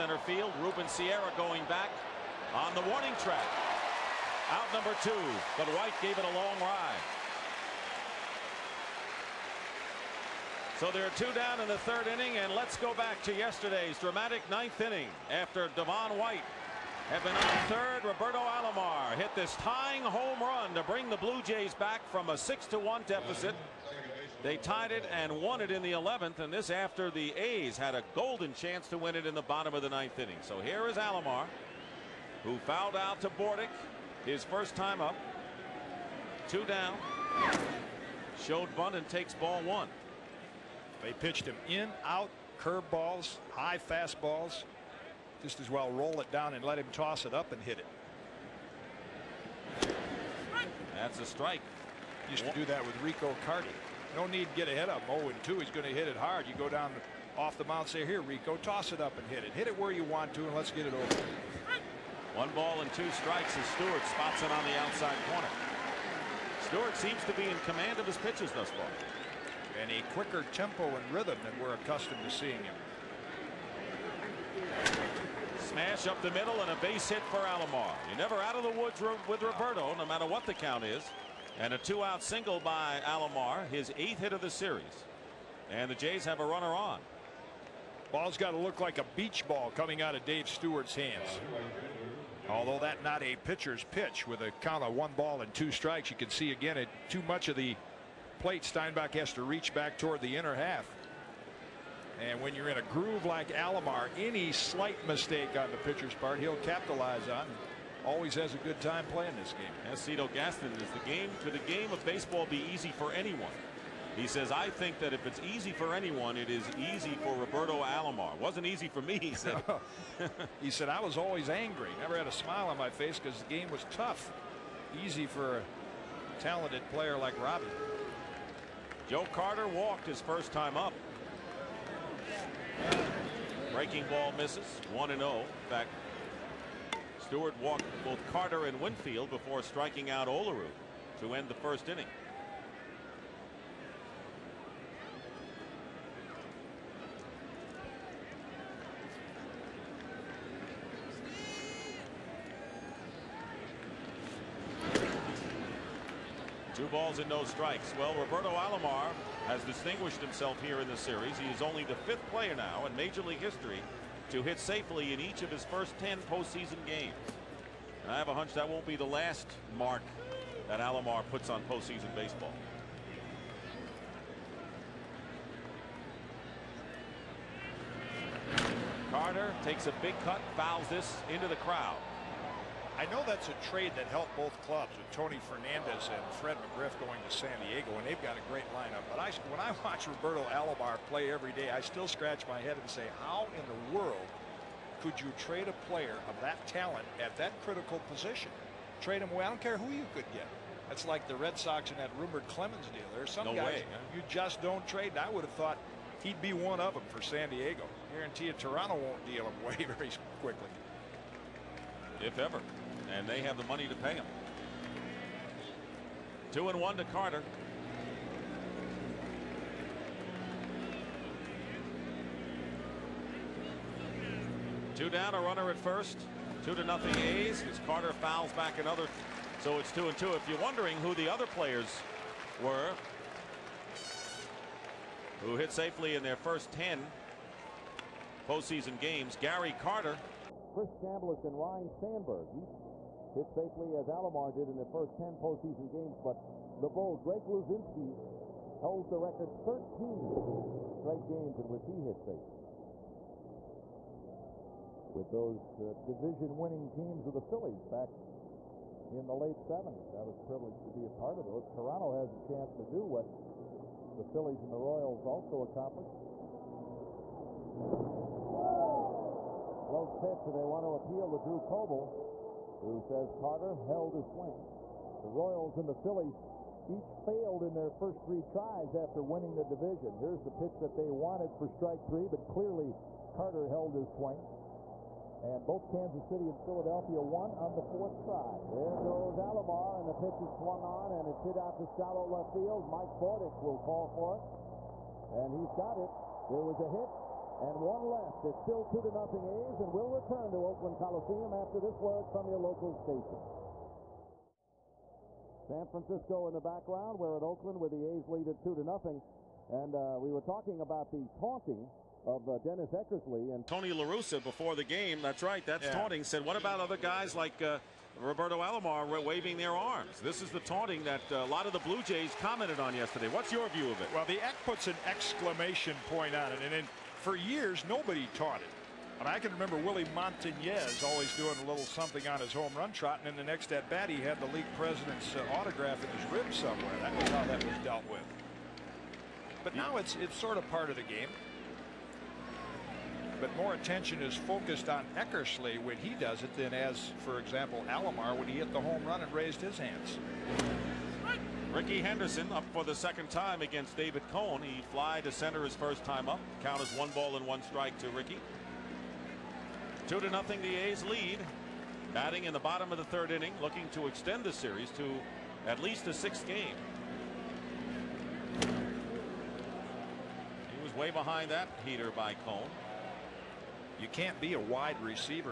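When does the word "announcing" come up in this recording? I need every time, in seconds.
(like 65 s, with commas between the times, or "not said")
not said.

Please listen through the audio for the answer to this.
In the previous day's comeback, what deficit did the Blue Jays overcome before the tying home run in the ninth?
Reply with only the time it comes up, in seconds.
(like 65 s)
22 s.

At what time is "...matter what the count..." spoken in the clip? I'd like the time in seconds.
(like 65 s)
80 s.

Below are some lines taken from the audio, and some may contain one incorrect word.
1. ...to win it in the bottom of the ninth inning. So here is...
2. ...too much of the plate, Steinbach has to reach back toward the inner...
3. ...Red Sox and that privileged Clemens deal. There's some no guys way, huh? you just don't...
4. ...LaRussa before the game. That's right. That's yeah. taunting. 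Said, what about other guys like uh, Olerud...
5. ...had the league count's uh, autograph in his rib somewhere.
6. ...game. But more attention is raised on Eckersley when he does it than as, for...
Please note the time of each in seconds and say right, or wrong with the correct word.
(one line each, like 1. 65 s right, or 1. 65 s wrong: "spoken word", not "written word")
1. 28 s right
2. 97 s right
3. 201 s wrong: "rumored", not "privileged"
4. 313 s wrong: "Roberto", not "Olerud"
5. 334 s wrong: "president", not "count"
6. 341 s wrong: "focused", not "raised".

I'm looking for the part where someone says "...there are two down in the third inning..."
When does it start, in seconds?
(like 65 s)
10 s.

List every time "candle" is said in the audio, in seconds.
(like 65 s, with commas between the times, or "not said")
not said.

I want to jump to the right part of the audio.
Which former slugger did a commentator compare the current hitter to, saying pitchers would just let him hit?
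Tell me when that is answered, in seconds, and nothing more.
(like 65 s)
53 s.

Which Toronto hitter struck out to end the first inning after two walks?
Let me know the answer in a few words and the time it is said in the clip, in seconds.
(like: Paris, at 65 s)
Olerud, at 140 s.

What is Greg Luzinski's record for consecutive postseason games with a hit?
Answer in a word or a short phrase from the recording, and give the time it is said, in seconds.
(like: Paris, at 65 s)
13, at 249 s.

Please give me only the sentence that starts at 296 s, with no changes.
There was a hit, and one left.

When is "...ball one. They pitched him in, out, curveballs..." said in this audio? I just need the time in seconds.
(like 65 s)
39 s.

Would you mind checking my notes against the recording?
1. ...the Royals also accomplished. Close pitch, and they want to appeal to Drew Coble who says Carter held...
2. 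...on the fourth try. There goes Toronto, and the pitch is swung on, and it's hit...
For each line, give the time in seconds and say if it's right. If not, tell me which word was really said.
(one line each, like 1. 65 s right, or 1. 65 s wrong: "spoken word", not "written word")
1. 264 s right
2. 287 s wrong: "Alomar", not "Toronto".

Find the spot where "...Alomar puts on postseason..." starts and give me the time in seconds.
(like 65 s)
170 s.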